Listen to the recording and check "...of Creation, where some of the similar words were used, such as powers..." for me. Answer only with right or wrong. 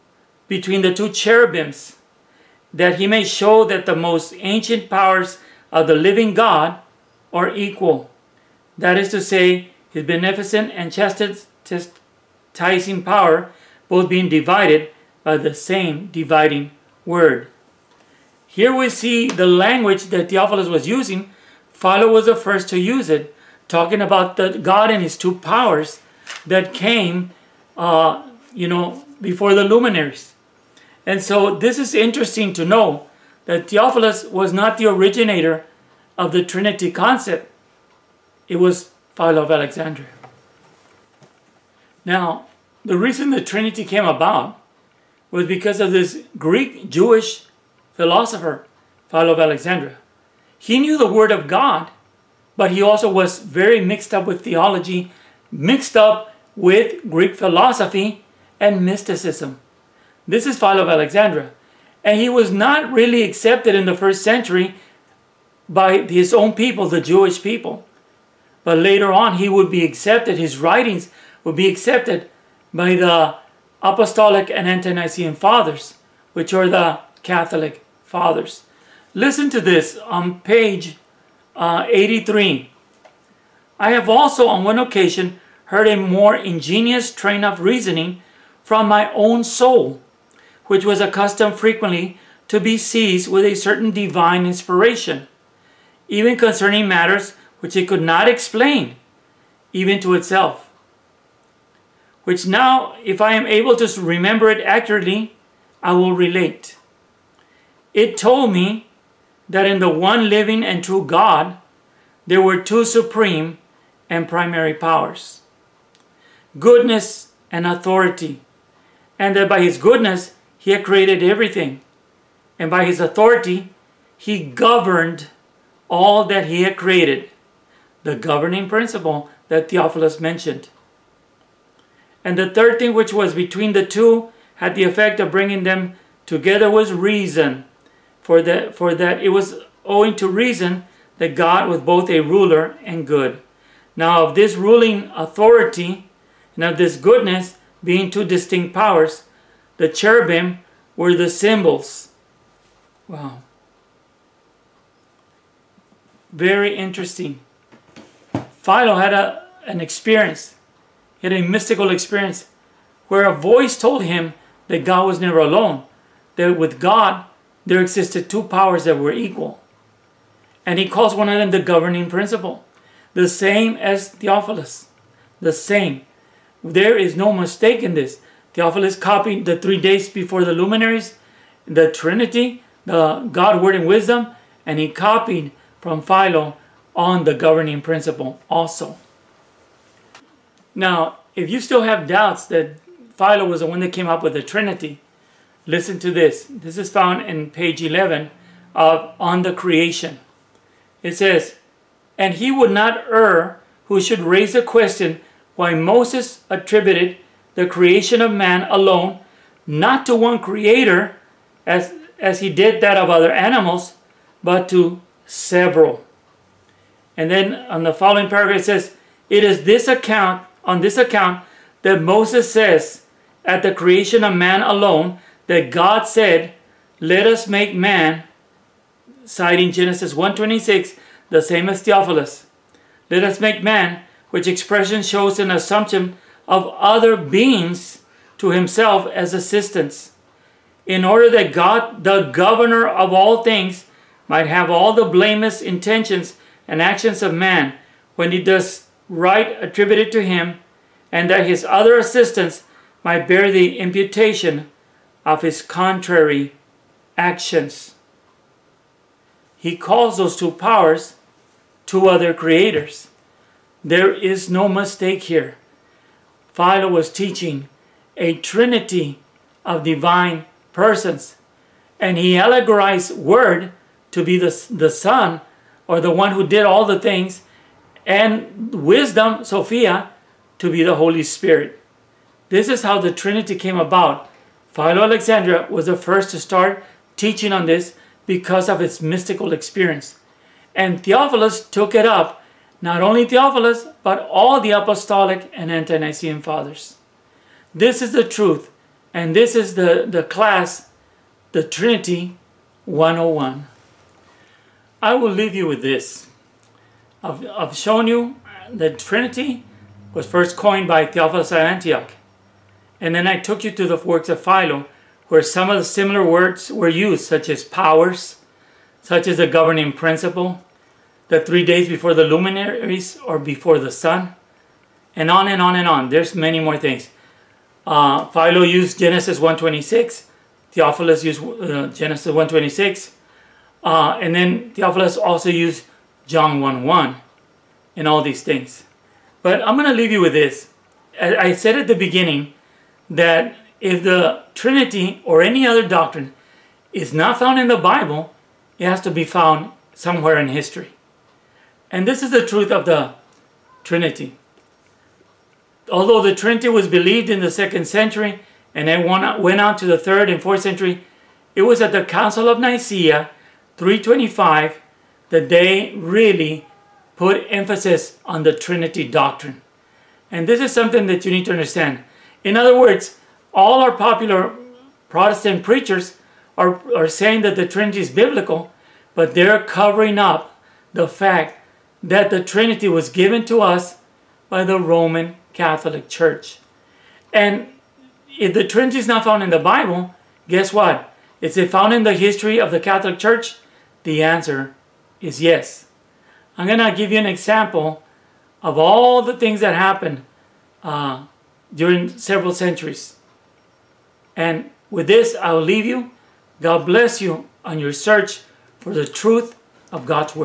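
wrong.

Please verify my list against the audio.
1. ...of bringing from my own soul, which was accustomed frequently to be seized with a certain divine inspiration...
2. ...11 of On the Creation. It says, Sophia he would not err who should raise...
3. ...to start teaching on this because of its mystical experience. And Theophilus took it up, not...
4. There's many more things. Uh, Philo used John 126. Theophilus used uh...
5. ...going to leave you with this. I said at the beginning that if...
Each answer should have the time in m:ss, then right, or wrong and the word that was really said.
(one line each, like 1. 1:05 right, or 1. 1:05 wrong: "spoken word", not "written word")
1. 1:27 wrong: "reasoning", not "bringing"
2. 3:17 wrong: "And", not "Sophia"
3. 4:46 right
4. 5:26 wrong: "Genesis", not "John"
5. 5:39 right.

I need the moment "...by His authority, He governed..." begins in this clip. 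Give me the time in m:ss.
2:02.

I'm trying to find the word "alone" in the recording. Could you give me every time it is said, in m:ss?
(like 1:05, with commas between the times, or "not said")
2:45, 3:28, 3:44.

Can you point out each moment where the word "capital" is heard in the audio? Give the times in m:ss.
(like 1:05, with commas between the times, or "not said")
not said.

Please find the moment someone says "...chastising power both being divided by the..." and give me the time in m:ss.
0:10.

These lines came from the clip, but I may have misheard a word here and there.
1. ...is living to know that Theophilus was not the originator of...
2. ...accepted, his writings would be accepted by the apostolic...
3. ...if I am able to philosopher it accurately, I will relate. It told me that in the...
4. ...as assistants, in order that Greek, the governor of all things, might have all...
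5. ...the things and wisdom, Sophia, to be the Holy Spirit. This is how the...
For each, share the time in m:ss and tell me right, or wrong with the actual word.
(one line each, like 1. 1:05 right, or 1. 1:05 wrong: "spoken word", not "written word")
1. 0:31 wrong: "interesting", not "living"
2. 1:09 right
3. 1:43 wrong: "remember", not "philosopher"
4. 3:59 wrong: "God", not "Greek"
5. 4:36 right.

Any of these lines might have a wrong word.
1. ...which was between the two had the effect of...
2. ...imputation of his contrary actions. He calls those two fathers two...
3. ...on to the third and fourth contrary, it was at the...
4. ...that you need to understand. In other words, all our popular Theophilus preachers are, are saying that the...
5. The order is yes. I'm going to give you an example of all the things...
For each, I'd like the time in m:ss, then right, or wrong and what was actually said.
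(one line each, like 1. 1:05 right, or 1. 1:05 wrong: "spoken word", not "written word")
1. 2:12 right
2. 4:13 wrong: "powers", not "fathers"
3. 5:59 wrong: "century", not "contrary"
4. 6:11 wrong: "Protestant", not "Theophilus"
5. 6:34 wrong: "answer", not "order".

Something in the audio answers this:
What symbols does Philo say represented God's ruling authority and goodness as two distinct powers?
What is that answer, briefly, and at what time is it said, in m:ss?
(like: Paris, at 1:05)
The cherubim, at 2:29.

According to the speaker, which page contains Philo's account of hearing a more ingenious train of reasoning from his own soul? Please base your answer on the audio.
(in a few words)
83.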